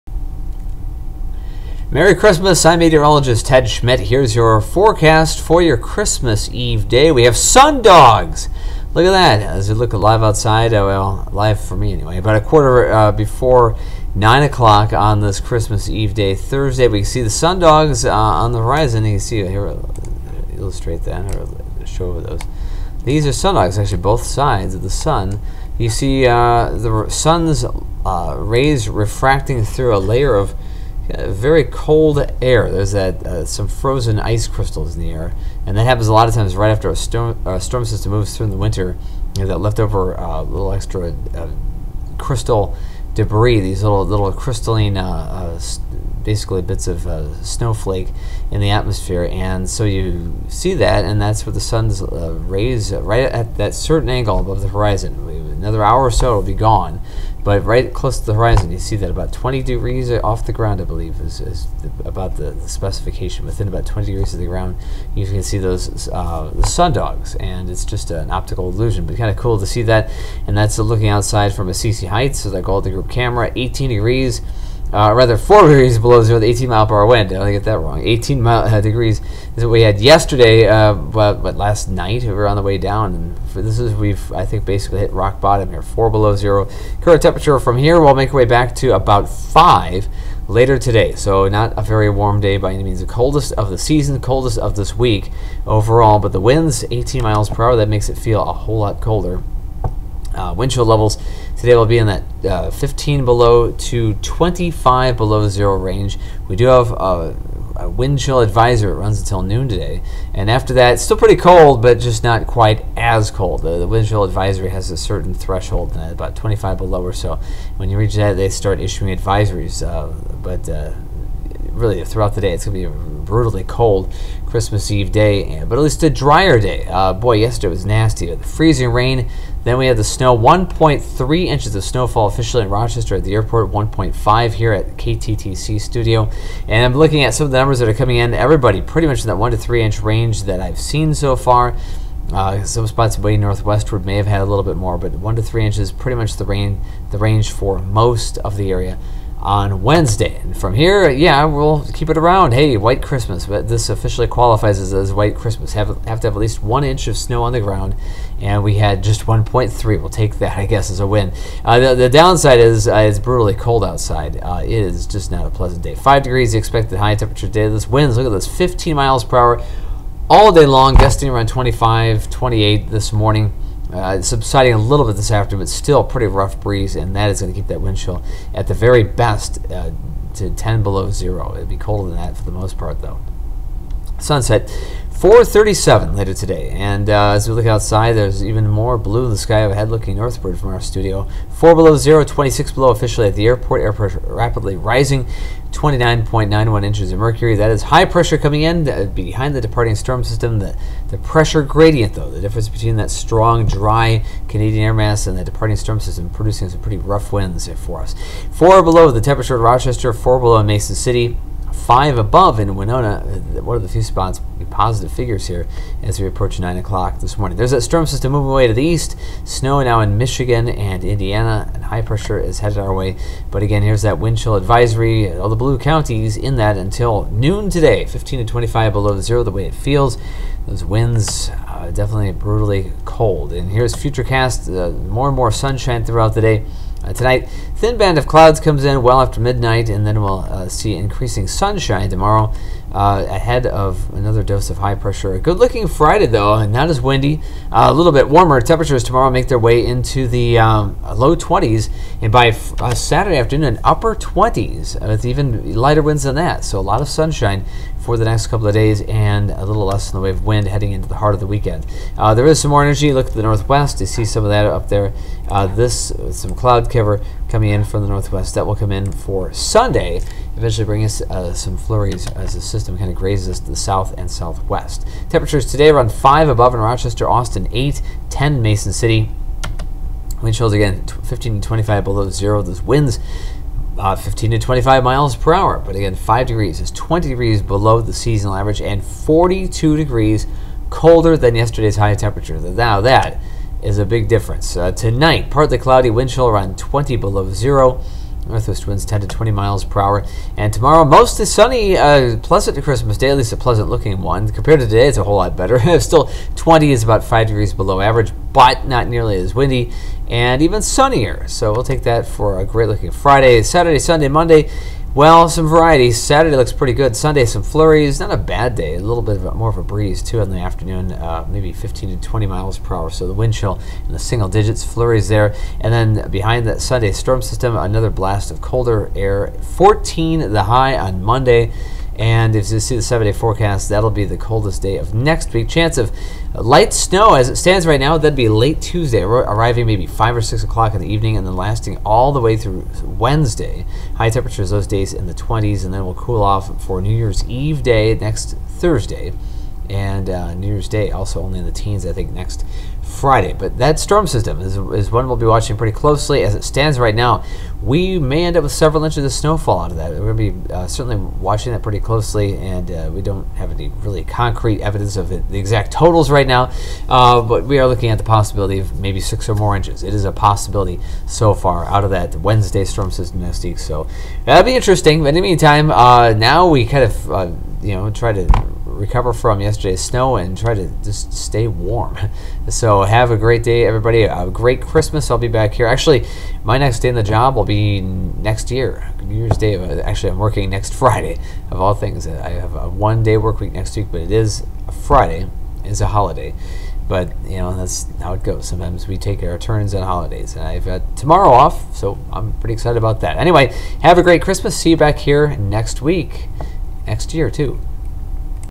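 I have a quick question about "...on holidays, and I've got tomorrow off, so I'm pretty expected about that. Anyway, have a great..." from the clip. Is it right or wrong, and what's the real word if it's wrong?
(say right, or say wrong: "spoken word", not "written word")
wrong: "excited", not "expected".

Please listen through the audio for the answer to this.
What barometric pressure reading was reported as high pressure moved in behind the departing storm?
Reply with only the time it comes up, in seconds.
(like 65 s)
195 s.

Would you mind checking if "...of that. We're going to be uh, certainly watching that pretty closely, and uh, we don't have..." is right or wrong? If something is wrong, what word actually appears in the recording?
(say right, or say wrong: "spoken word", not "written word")
right.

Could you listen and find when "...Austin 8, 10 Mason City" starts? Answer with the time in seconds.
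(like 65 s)
277 s.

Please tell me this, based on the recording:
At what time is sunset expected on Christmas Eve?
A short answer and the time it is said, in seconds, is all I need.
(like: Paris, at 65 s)
4:37, at 185 s.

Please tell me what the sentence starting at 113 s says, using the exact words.
The, the wind chill advisory has a certain threshold, uh, about 25 below or so.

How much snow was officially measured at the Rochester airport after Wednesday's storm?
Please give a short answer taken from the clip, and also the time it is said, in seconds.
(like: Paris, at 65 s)
1.3 inches, at 130 s.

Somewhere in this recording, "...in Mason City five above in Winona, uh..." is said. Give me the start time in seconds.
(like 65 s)
210 s.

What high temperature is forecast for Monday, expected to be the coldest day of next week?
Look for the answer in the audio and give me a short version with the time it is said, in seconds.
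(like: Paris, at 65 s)
14, at 329 s.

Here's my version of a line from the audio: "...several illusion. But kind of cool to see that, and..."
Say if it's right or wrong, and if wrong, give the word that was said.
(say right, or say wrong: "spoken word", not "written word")
wrong: "optical", not "several".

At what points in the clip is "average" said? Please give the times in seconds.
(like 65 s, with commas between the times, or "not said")
288 s, 308 s.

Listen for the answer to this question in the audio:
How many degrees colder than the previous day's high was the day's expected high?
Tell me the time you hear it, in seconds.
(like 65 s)
289 s.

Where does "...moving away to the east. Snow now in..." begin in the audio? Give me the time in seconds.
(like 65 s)
218 s.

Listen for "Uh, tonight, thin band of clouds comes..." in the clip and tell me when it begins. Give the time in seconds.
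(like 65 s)
237 s.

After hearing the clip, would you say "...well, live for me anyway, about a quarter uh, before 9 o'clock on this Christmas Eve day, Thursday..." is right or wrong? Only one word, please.
right.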